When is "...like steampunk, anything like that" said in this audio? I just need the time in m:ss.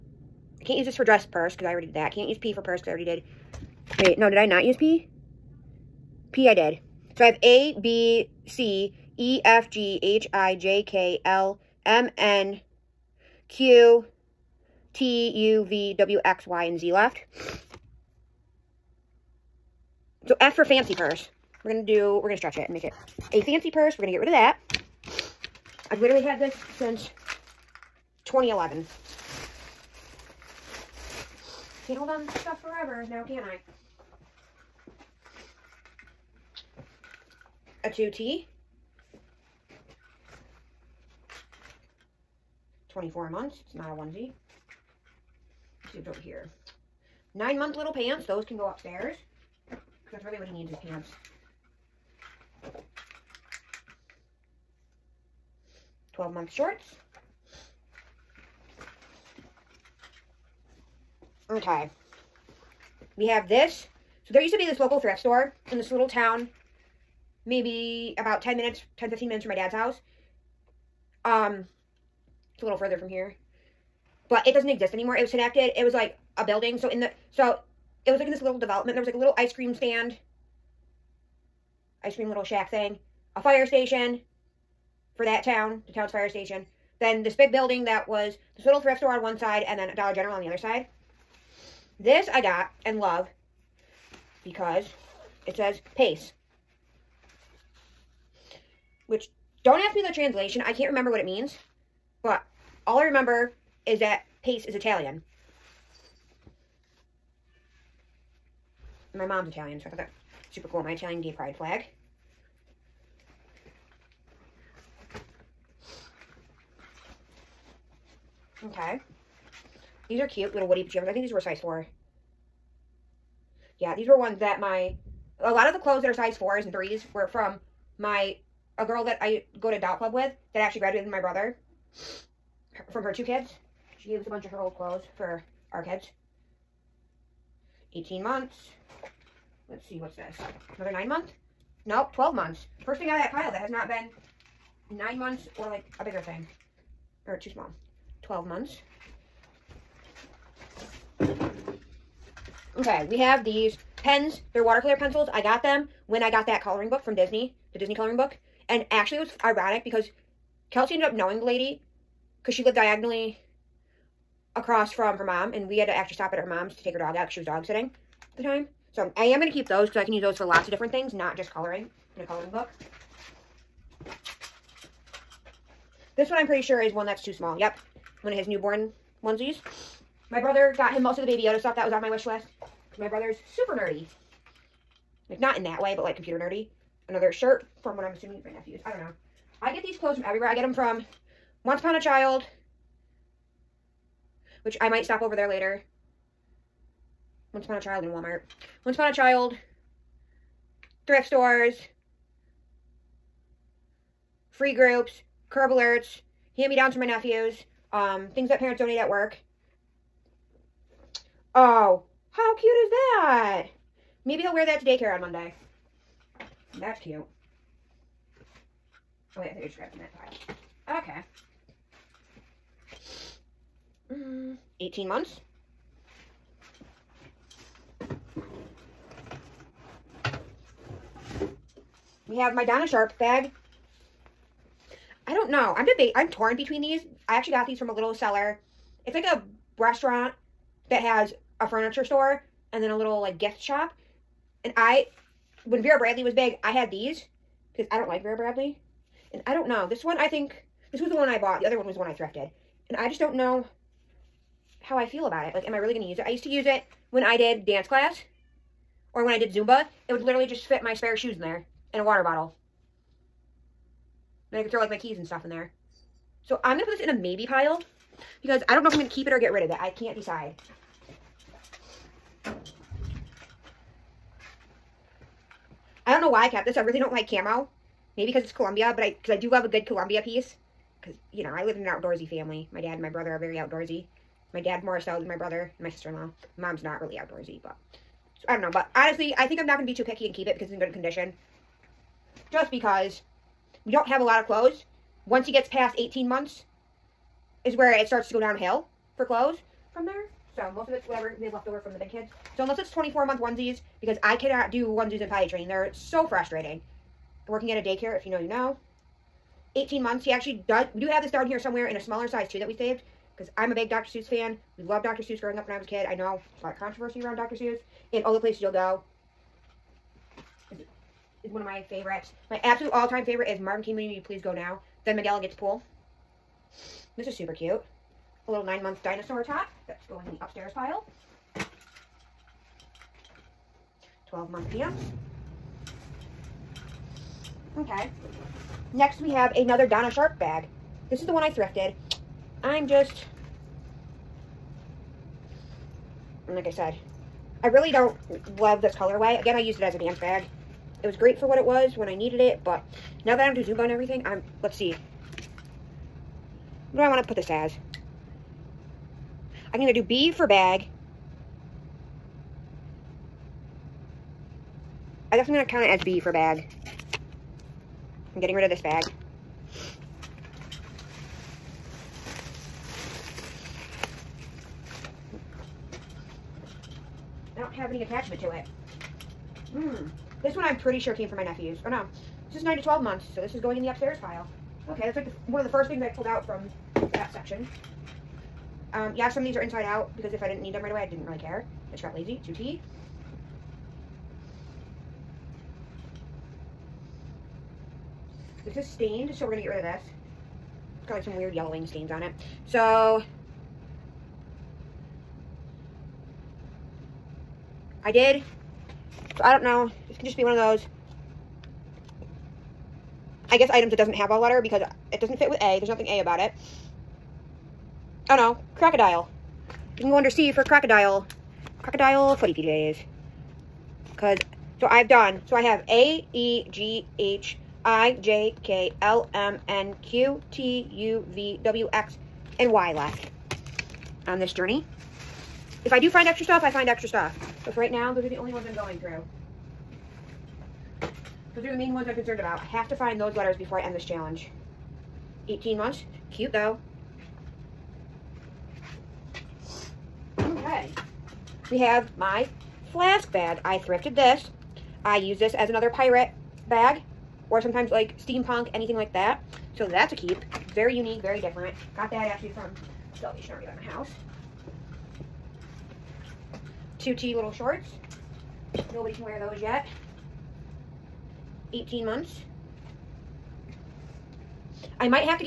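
7:37.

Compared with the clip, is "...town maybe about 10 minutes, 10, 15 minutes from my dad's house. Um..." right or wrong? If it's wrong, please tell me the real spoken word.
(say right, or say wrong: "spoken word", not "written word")
right.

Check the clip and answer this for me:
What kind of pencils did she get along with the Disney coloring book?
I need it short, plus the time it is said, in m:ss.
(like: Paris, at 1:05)
Watercolor pencils, at 2:34.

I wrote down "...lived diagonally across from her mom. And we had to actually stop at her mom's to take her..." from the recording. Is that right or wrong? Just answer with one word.
right.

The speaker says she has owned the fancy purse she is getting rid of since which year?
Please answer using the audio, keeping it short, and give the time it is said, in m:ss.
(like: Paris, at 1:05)
2011, at 0:28.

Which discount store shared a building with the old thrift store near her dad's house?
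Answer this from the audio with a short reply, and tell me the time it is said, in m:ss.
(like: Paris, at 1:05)
Dollar General, at 1:29.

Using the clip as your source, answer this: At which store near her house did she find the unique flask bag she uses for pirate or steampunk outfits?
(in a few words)
Salvation Army.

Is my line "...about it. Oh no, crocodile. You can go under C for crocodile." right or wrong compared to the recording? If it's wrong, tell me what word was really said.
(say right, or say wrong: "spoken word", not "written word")
right.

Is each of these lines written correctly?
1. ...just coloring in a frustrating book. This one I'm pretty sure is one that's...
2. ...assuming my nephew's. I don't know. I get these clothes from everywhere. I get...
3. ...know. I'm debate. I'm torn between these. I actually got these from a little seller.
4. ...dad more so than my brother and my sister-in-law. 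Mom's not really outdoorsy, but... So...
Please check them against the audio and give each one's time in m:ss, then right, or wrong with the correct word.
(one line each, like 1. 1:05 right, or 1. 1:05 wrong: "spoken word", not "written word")
1. 2:51 wrong: "coloring", not "frustrating"
2. 3:08 right
3. 3:55 right
4. 4:44 right.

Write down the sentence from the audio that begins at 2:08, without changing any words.
A girl that I go to Dot Club with that actually graduated my brother her, from her two kids.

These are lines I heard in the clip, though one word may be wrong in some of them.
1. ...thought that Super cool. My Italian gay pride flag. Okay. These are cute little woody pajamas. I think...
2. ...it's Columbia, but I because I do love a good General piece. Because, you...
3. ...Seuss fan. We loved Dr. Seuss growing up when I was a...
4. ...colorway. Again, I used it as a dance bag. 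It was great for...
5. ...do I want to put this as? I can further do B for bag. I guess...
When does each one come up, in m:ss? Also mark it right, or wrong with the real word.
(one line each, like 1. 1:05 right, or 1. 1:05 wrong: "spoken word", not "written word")
1. 1:49 right
2. 4:38 wrong: "Columbia", not "General"
3. 5:14 right
4. 5:48 right
5. 5:56 wrong: "either", not "further".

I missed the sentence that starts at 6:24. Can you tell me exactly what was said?
Okay, that's like the, one of the first things I pulled out from that section.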